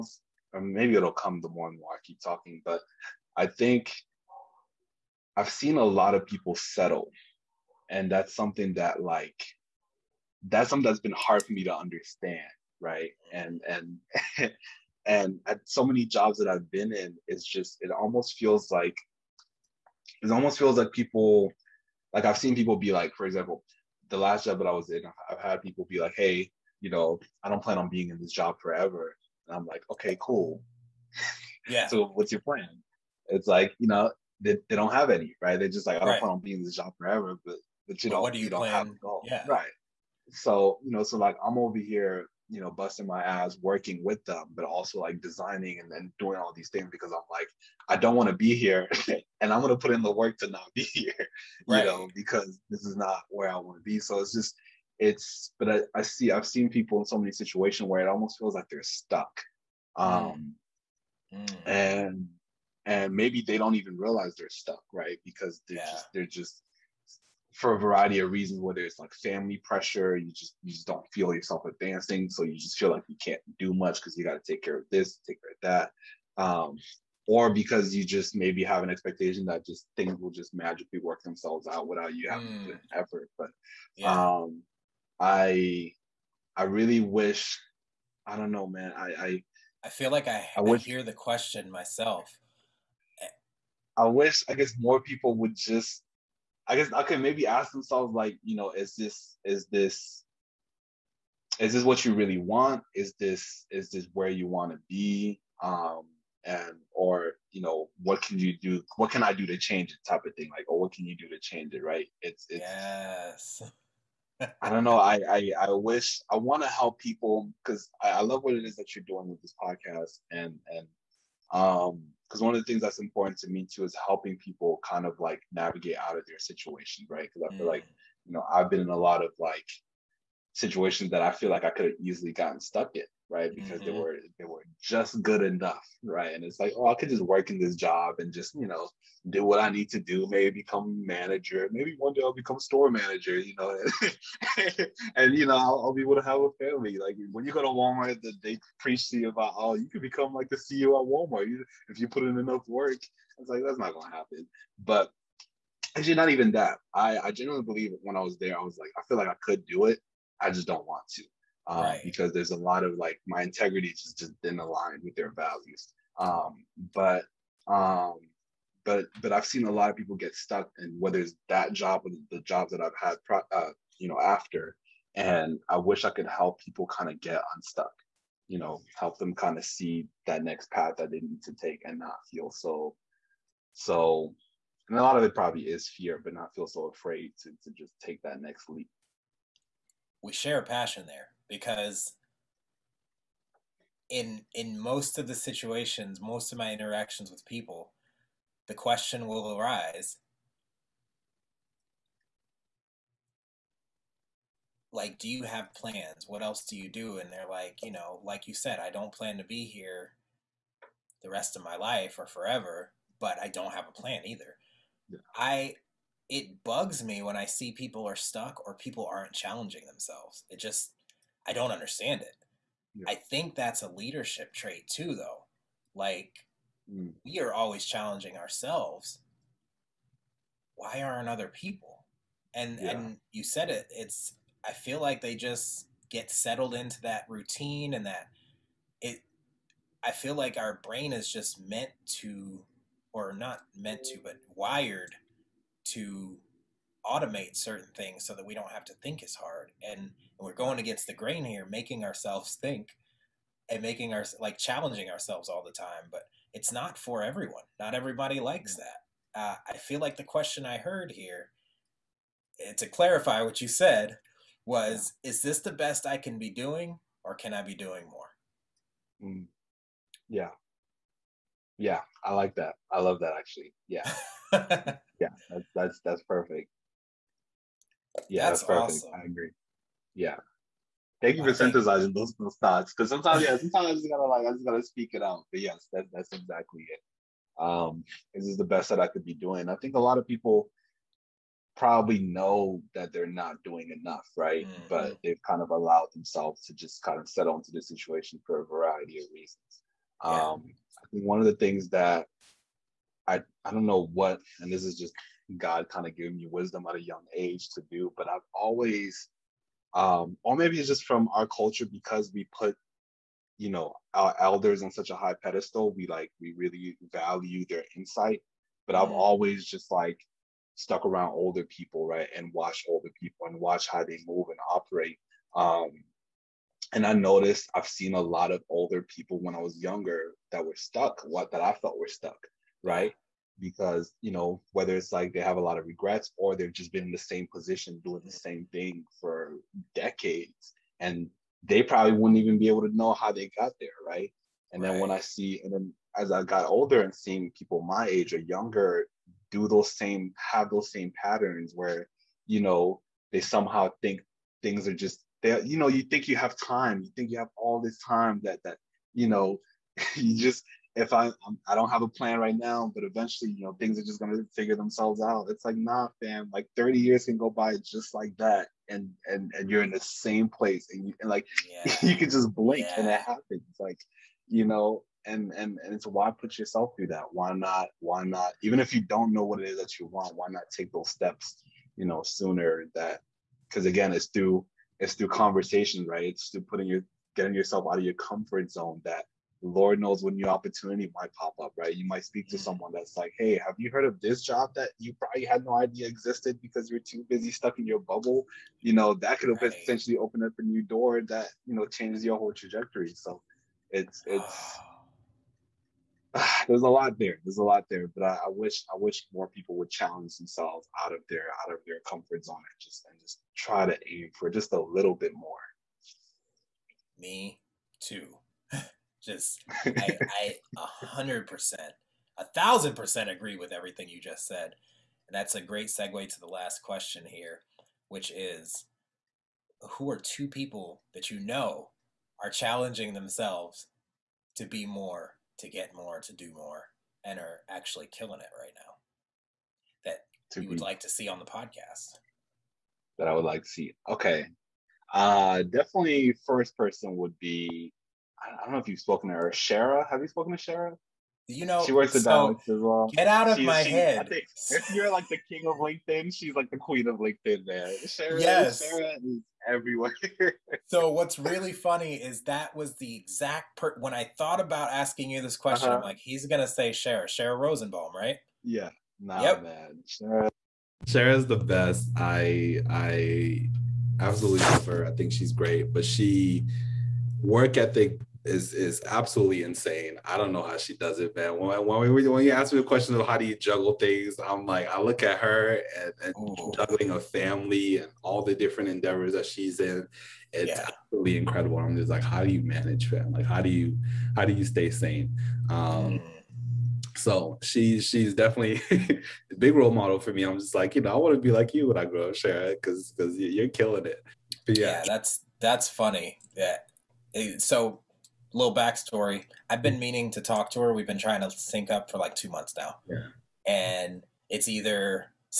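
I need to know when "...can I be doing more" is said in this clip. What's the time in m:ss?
4:27.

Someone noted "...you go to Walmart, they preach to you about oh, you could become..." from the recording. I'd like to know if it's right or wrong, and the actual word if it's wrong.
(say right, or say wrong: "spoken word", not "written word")
right.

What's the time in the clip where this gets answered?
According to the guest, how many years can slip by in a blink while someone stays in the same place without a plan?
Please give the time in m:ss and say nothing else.
6:06.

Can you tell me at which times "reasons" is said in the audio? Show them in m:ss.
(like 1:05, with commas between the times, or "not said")
1:08, 4:59.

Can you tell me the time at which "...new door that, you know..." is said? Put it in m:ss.
6:40.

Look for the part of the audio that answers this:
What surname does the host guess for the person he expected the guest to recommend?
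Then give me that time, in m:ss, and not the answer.
7:47.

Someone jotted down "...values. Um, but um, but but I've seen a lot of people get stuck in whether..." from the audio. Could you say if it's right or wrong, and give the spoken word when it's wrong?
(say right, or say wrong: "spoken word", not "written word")
right.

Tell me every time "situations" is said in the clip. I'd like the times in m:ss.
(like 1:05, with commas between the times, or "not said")
0:57, 2:06, 2:10, 3:15, 4:57.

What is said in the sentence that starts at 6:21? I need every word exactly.
You know, sooner that because again, it's through it's through conversation, right?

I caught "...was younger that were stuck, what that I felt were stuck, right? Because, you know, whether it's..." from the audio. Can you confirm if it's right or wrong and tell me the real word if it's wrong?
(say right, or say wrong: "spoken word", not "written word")
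right.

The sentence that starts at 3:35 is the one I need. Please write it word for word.
i it bugs me when I see people are stuck or people aren't challenging themselves.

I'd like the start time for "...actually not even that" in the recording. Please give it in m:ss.
2:35.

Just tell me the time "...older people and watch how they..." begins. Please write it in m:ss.
5:22.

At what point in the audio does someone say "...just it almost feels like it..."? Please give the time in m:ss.
0:17.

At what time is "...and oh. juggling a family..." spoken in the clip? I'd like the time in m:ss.
8:06.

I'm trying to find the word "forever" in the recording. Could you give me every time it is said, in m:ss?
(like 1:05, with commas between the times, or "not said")
0:28, 0:36, 3:32.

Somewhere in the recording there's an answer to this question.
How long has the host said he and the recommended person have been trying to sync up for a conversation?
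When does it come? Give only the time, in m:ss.
8:32.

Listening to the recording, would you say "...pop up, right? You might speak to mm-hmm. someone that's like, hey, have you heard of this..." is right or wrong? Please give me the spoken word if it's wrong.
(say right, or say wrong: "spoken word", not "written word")
right.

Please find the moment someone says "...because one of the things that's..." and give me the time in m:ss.
2:02.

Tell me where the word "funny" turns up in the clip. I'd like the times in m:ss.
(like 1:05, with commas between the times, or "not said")
7:41, 8:25.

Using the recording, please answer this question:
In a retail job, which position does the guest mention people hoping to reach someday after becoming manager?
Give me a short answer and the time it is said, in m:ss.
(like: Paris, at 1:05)
store manager, at 2:22.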